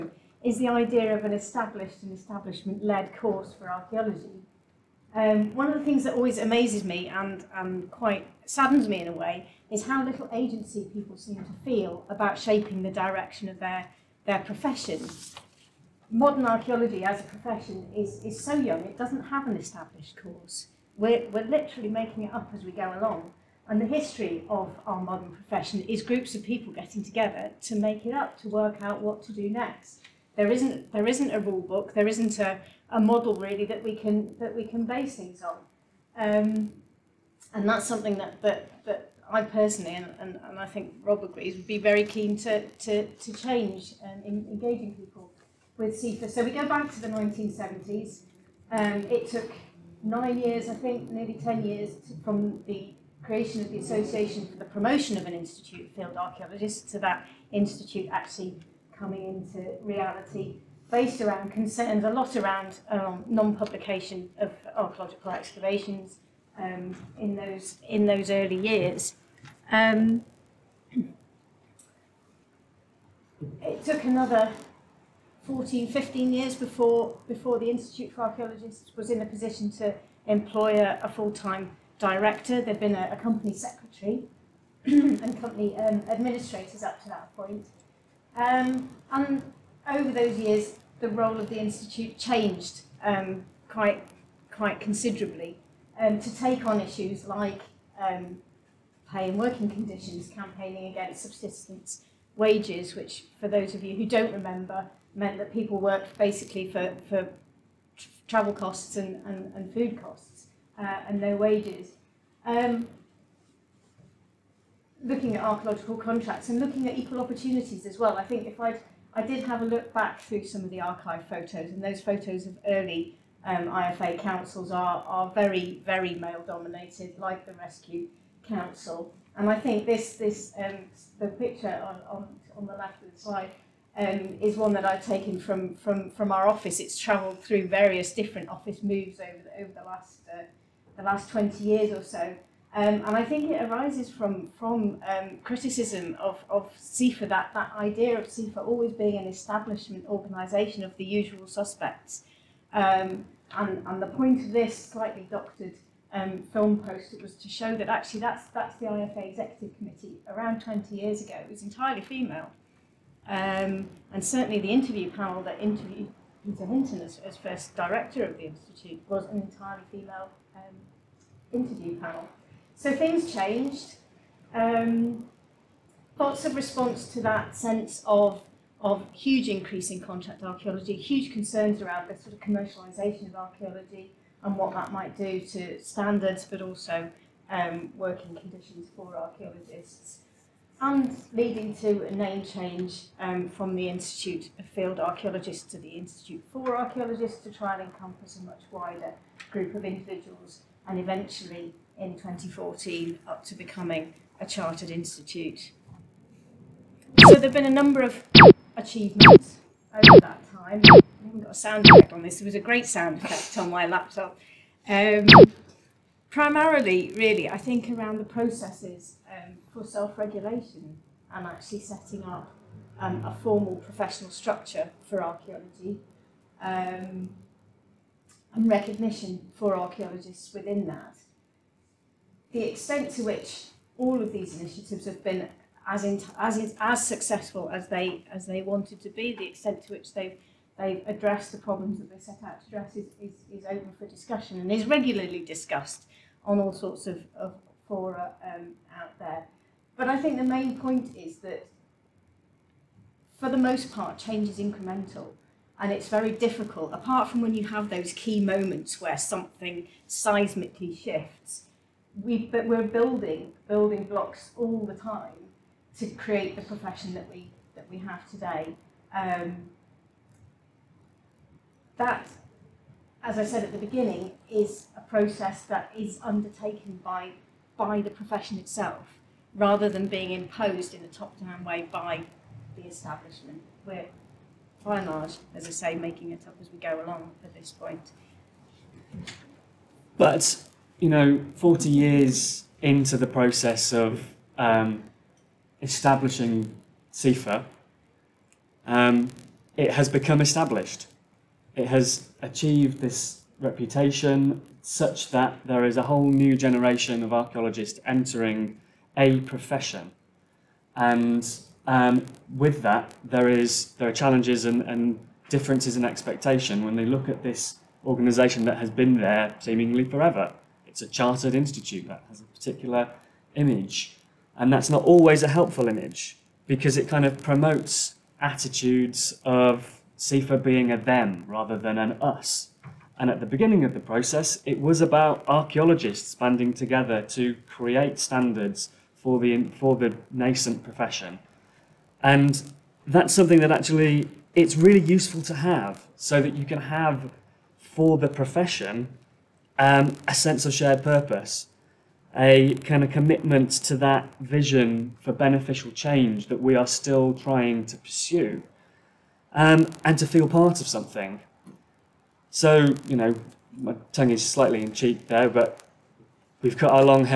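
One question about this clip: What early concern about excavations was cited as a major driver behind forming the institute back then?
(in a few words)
non-publication.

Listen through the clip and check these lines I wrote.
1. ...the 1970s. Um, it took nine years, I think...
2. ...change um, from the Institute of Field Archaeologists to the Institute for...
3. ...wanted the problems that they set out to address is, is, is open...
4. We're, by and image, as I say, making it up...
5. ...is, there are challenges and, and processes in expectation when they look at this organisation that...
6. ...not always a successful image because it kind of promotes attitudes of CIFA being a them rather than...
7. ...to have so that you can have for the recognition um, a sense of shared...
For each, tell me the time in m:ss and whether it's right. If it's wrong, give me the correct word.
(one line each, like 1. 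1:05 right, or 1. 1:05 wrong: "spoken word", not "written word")
1. 0:47 right
2. 3:12 right
3. 4:01 wrong: "addressed", not "wanted"
4. 4:43 wrong: "large", not "image"
5. 5:13 wrong: "differences", not "processes"
6. 5:24 wrong: "helpful", not "successful"
7. 5:45 wrong: "profession", not "recognition".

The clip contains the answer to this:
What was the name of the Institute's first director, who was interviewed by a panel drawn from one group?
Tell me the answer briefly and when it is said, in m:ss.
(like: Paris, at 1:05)
Peter Hinton, at 2:46.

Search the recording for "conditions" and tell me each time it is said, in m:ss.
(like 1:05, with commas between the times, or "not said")
1:39, 3:08.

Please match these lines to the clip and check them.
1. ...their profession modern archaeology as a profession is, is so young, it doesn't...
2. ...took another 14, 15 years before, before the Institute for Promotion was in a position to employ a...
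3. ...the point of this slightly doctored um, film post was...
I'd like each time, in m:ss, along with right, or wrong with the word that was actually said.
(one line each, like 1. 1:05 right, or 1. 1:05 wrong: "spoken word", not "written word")
1. 0:14 right
2. 1:13 wrong: "Archaeologists", not "Promotion"
3. 2:34 right.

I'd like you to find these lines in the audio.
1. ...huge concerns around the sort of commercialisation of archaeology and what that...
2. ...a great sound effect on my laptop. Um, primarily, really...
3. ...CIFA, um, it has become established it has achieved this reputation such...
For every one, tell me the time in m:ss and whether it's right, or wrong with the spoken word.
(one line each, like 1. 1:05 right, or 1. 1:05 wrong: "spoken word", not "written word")
1. 3:00 right
2. 3:32 right
3. 4:57 right.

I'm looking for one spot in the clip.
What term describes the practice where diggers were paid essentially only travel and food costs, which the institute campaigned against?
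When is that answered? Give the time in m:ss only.
1:41.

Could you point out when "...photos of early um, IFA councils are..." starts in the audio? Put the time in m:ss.
2:02.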